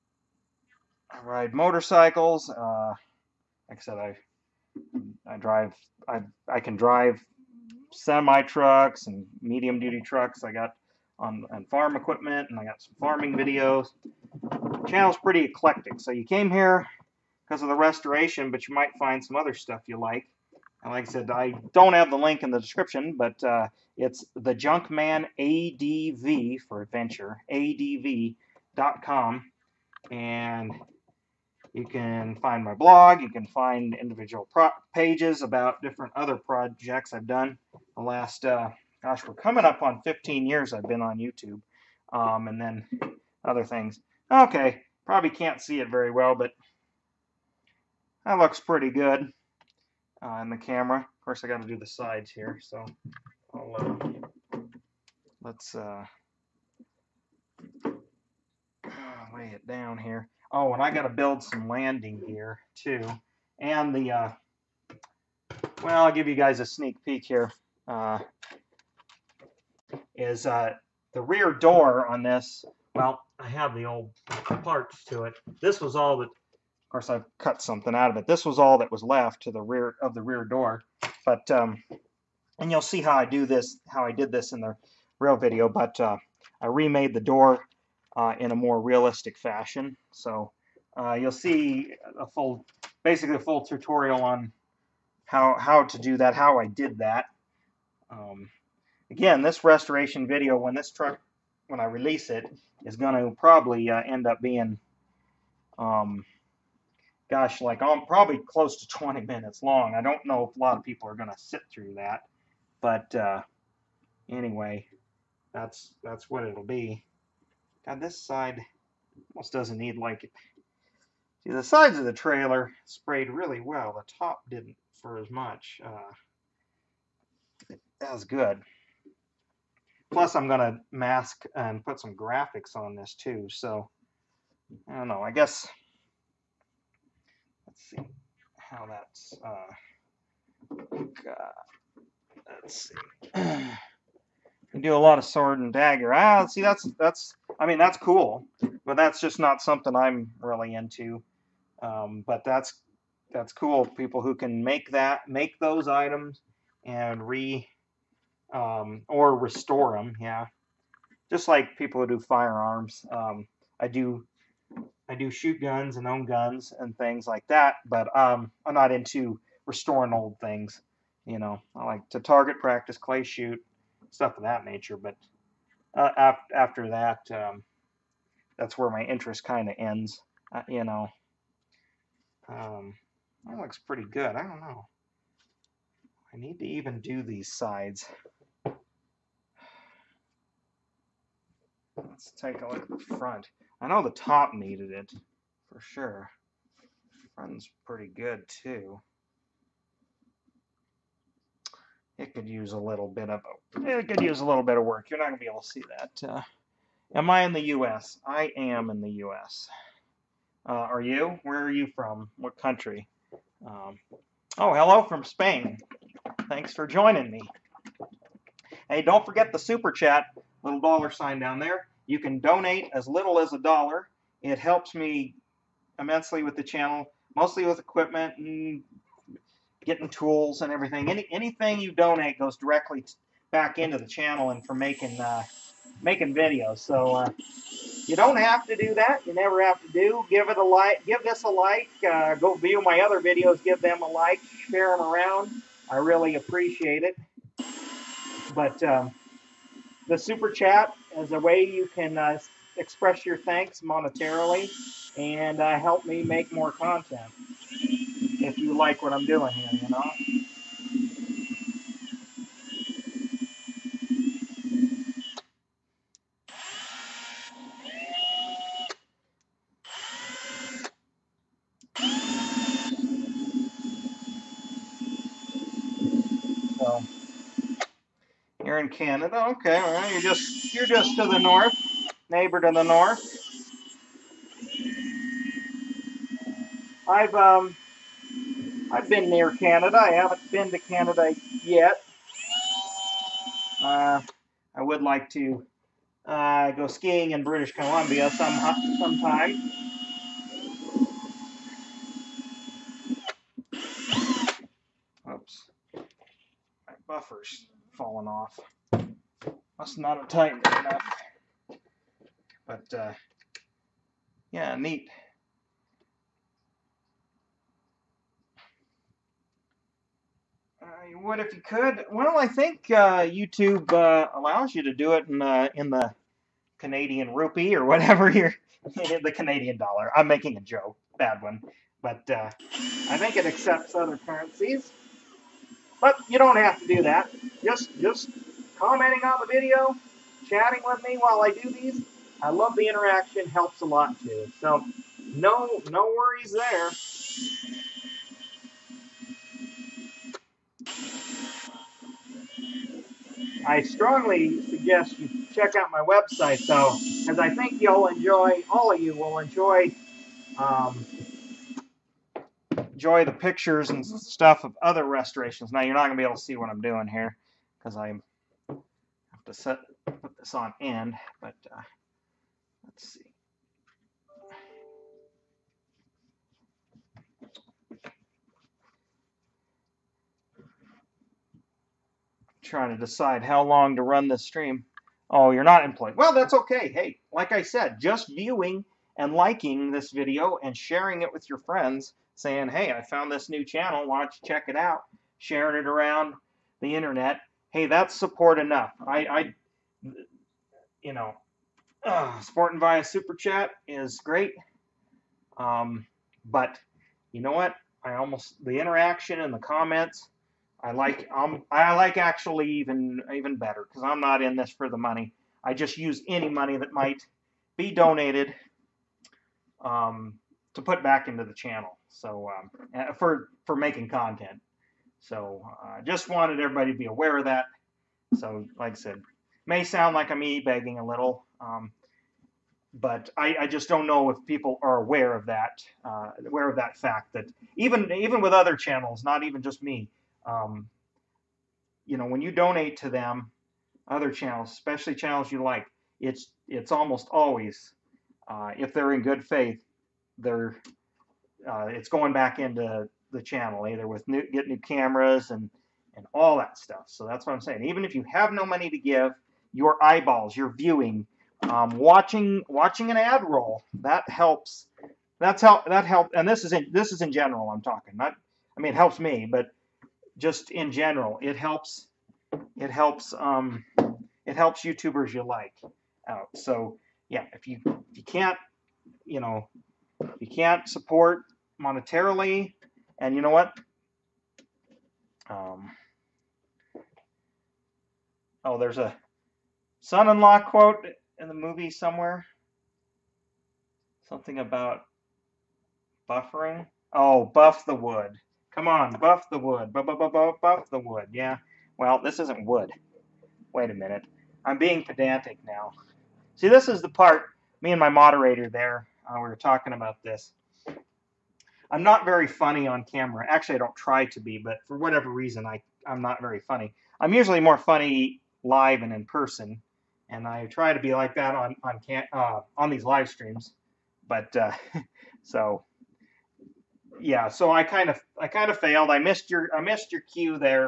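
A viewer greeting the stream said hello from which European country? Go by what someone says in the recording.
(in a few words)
Spain.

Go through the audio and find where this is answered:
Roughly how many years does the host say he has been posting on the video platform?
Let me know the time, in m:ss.
0:40.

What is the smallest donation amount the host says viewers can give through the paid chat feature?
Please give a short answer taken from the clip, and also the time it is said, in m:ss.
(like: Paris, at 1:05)
a dollar, at 3:43.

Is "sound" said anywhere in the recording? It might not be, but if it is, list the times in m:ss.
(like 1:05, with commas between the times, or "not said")
7:09.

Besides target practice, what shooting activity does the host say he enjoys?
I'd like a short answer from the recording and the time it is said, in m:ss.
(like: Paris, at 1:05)
clay shoot, at 2:52.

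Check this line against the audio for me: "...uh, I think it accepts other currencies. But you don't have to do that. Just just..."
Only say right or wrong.
right.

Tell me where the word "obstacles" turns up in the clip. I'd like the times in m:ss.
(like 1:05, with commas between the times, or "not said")
not said.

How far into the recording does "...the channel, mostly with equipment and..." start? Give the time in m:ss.
3:46.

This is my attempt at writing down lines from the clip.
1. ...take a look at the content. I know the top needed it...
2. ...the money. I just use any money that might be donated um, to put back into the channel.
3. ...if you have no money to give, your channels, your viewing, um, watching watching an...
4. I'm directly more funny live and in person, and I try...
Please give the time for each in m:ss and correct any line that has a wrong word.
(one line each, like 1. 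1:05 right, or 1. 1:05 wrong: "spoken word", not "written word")
1. 3:12 wrong: "front", not "content"
2. 6:54 right
3. 7:38 wrong: "eyeballs", not "channels"
4. 8:37 wrong: "usually", not "directly".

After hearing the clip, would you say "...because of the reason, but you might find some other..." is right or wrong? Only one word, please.
wrong.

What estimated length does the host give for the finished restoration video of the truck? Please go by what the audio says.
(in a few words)
20 minutes.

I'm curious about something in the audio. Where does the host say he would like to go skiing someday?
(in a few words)
British Columbia.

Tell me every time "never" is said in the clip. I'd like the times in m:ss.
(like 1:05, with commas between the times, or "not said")
3:59.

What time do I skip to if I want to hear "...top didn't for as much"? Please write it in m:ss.
2:04.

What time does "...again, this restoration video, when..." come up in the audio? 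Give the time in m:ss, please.
1:39.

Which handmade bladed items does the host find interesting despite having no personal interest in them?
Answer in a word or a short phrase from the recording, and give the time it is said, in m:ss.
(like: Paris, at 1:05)
sword and dagger, at 2:25.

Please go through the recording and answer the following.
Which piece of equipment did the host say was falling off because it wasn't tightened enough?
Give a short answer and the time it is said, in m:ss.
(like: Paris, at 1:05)
buffer, at 5:07.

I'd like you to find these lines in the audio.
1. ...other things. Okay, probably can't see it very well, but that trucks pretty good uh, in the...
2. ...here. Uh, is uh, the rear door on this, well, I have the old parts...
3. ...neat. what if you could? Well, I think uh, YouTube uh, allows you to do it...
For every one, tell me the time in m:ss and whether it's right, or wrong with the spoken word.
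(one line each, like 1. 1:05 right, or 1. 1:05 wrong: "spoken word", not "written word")
1. 0:43 wrong: "looks", not "trucks"
2. 1:07 right
3. 5:14 right.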